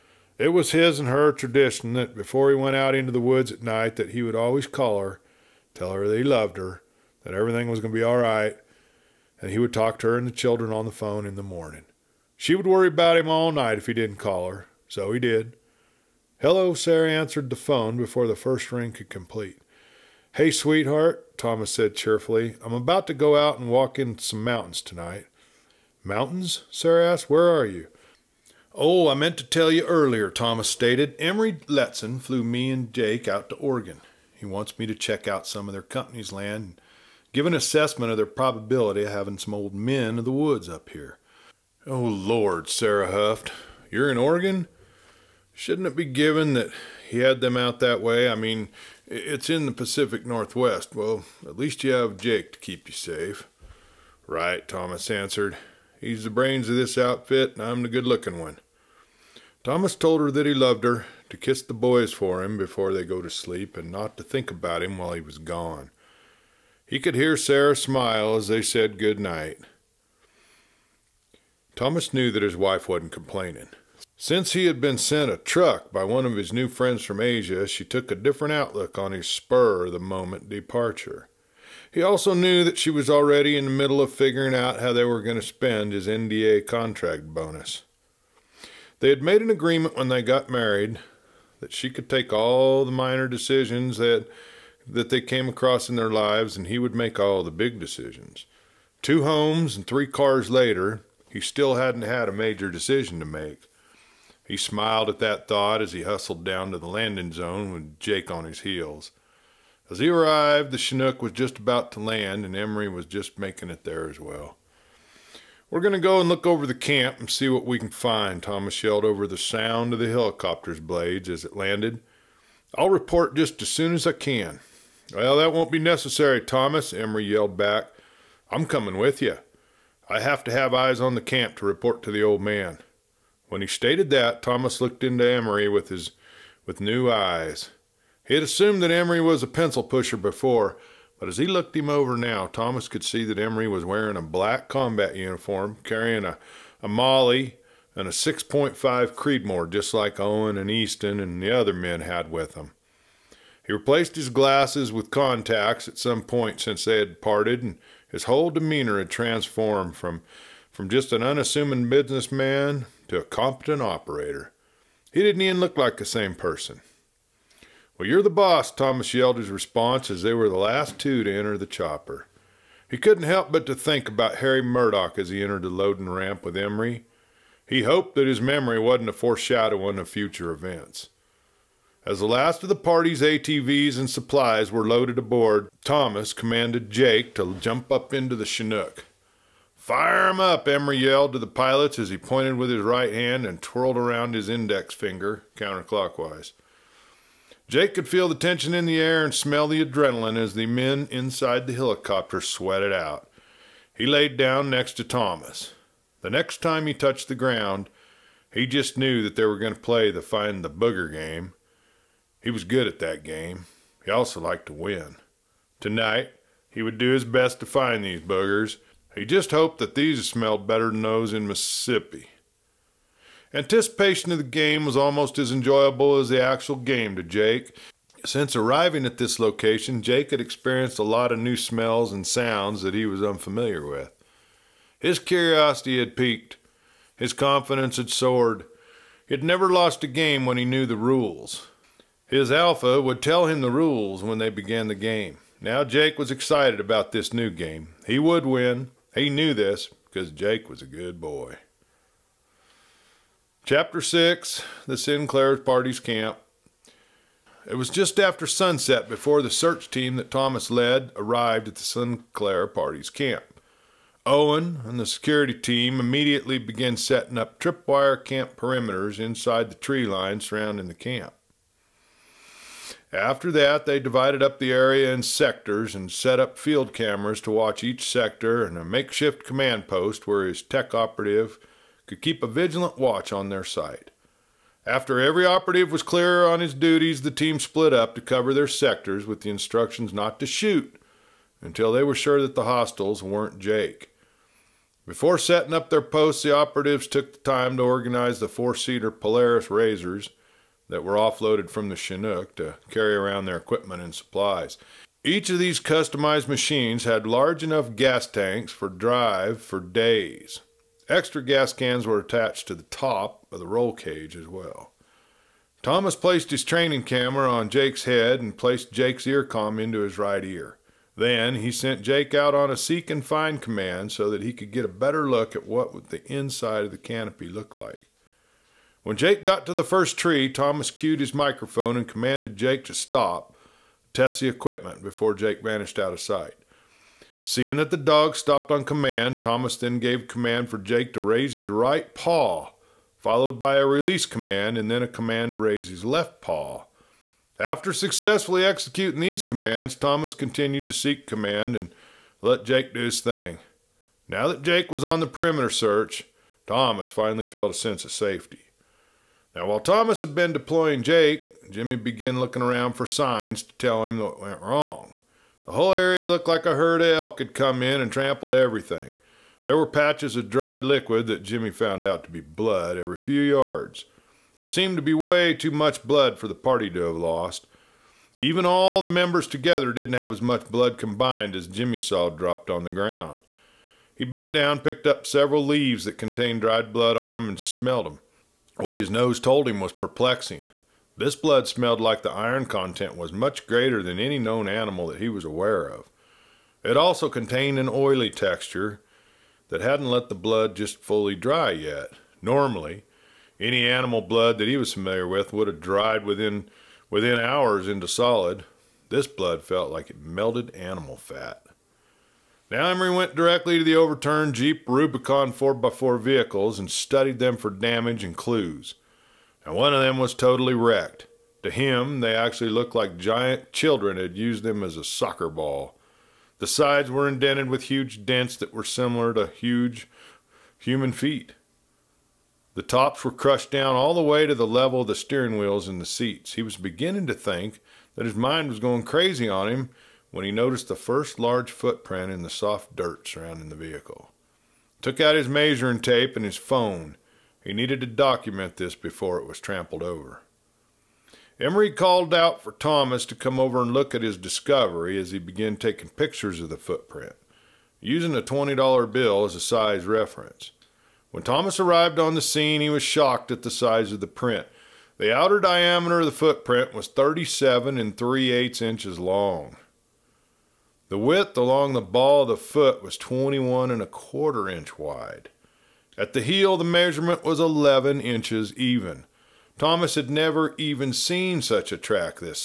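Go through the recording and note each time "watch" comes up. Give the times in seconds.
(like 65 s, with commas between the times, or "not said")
277 s, 282 s.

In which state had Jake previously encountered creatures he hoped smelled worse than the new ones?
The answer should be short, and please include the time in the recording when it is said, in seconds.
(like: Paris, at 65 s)
Mississippi, at 221 s.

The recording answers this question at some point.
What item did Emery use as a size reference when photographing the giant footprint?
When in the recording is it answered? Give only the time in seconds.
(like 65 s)
458 s.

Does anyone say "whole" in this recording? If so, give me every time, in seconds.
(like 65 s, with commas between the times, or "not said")
158 s, 365 s.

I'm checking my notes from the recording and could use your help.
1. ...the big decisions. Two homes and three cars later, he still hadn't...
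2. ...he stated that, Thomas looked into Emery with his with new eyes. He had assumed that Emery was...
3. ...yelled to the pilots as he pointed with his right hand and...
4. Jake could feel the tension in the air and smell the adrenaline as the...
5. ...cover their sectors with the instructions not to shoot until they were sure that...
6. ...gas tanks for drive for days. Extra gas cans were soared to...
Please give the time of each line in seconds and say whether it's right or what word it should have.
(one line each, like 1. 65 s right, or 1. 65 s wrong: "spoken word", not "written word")
1. 97 s right
2. 133 s right
3. 190 s right
4. 197 s right
5. 288 s right
6. 307 s wrong: "attached", not "soared".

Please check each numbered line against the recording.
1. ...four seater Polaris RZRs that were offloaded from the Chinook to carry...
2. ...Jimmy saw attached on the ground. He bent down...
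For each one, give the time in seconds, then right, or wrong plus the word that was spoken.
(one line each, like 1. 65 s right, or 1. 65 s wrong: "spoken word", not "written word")
1. 298 s right
2. 381 s wrong: "dropped", not "attached".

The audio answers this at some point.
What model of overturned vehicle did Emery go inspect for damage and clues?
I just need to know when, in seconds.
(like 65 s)
414 s.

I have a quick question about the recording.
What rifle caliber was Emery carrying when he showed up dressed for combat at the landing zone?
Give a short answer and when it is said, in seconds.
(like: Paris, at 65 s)
6.5 Creedmoor, at 148 s.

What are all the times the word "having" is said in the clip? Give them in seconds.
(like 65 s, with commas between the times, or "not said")
39 s.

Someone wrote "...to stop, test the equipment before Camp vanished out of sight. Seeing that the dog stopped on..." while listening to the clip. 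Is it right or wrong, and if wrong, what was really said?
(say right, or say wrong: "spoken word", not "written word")
wrong: "Jake", not "Camp".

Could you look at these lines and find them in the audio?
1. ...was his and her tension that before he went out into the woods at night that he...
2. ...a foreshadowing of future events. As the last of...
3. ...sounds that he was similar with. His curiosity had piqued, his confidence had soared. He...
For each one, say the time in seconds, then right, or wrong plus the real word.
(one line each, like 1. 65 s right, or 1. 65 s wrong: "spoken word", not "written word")
1. 0 s wrong: "tradition", not "tension"
2. 179 s right
3. 232 s wrong: "unfamiliar", not "similar".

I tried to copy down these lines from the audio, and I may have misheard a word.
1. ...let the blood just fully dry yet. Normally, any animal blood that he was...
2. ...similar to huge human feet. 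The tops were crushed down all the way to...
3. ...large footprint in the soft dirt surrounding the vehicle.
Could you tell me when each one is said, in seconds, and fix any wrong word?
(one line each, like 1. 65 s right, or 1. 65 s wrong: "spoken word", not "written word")
1. 400 s right
2. 428 s right
3. 441 s right.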